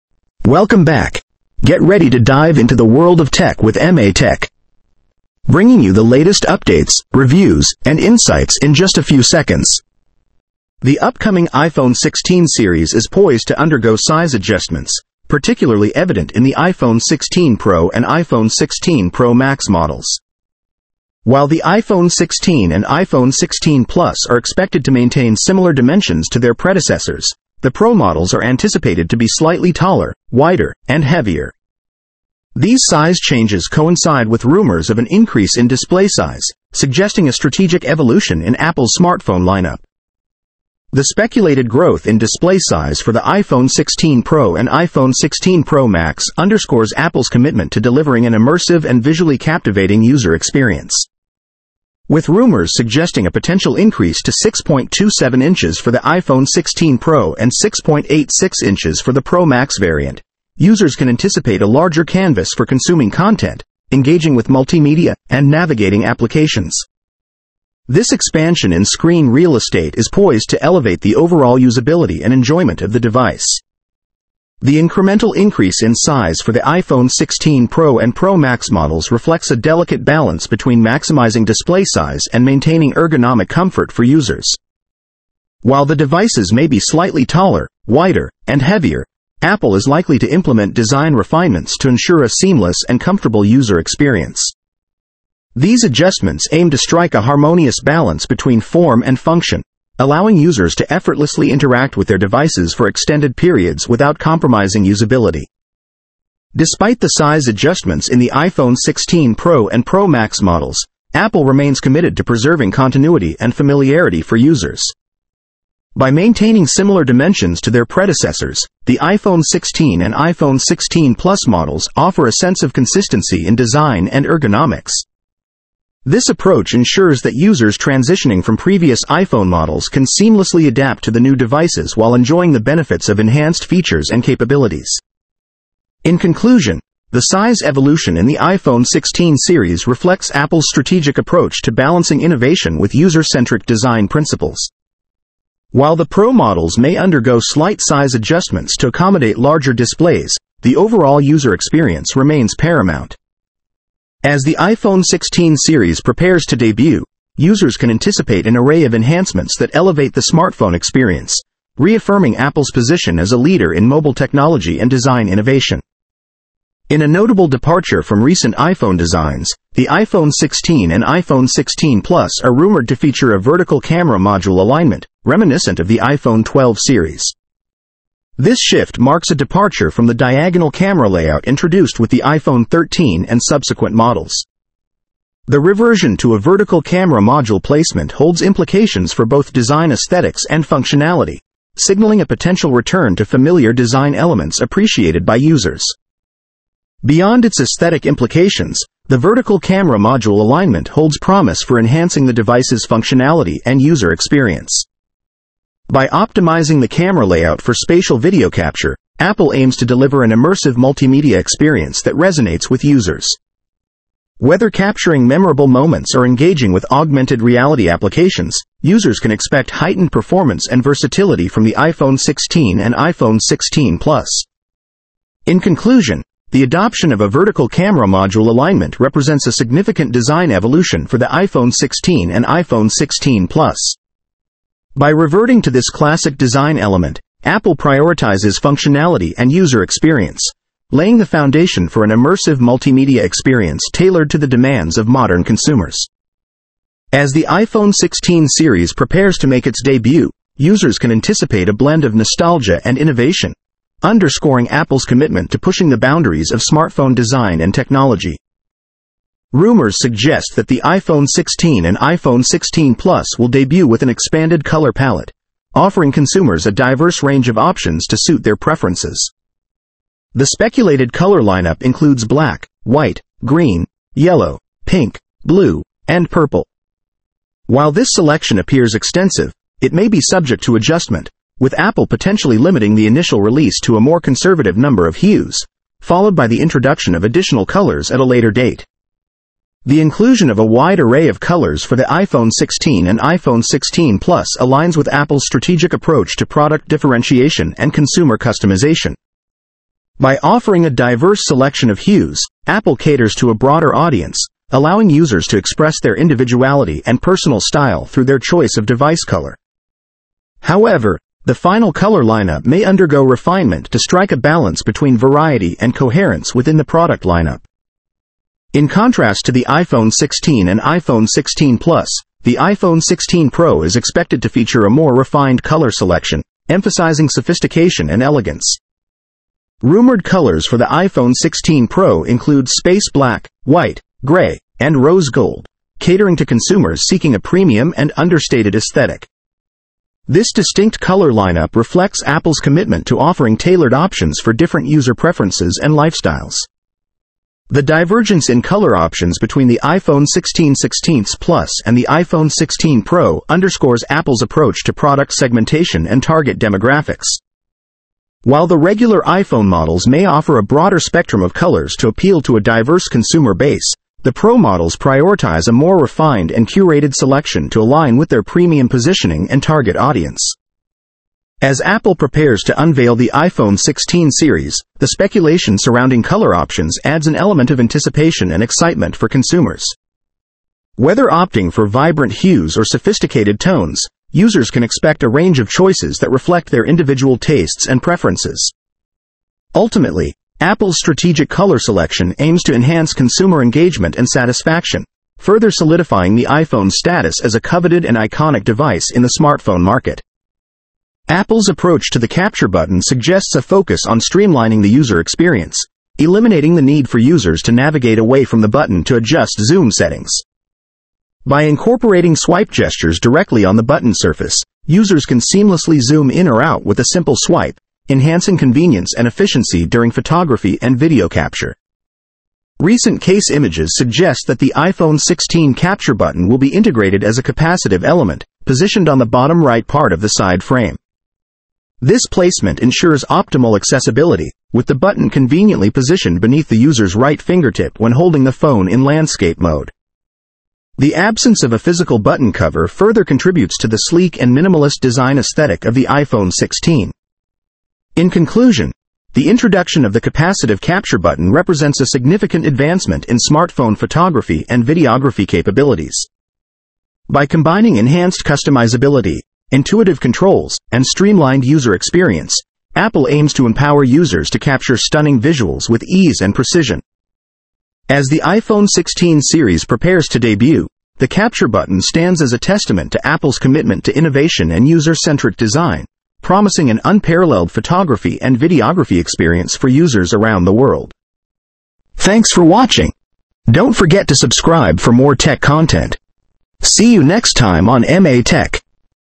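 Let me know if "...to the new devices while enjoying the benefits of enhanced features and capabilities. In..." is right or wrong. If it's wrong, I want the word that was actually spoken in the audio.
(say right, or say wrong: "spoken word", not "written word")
right.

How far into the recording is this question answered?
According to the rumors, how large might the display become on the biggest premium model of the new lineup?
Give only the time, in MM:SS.
00:57.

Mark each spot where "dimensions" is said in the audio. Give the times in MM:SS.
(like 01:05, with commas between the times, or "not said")
00:25, 01:57.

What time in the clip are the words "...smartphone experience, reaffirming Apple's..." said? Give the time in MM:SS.
02:40.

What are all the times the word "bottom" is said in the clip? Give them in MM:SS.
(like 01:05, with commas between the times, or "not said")
07:09.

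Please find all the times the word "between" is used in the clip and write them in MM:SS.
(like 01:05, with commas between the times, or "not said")
01:20, 01:38, 05:14, 05:49.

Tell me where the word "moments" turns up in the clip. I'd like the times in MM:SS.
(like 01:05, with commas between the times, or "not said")
03:35.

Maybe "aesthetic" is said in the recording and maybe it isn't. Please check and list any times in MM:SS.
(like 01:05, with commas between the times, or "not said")
03:09, 03:17, 05:38, 07:25.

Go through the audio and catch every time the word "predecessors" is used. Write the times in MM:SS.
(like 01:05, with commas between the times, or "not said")
00:26, 01:57.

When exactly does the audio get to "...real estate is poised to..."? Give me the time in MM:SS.
01:09.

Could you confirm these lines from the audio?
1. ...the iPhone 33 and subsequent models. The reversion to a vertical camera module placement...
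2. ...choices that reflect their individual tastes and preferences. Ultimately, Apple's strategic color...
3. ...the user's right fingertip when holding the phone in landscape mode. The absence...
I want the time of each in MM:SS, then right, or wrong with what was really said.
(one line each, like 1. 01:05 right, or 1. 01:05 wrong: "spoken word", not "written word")
1. 03:02 wrong: "13", not "33"
2. 06:25 right
3. 07:16 right.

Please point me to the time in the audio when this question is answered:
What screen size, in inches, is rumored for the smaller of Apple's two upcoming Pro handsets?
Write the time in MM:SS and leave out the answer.
00:54.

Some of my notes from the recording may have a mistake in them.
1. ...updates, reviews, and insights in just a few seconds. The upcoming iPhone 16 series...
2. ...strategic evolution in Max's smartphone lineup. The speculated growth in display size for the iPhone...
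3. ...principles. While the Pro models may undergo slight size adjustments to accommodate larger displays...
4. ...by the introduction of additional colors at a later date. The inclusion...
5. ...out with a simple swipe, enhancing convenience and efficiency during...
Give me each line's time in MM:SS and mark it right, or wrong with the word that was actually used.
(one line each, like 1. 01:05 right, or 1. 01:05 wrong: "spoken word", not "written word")
1. 00:06 right
2. 00:37 wrong: "Apple", not "Max"
3. 02:24 right
4. 04:46 right
5. 06:56 right.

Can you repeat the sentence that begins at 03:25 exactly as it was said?
By optimizing the camera layout for spatial video capture, Apple aims to deliver an immersive multimedia experience that resonates with users.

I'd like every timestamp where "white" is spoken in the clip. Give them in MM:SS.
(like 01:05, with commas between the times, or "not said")
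04:32, 05:33.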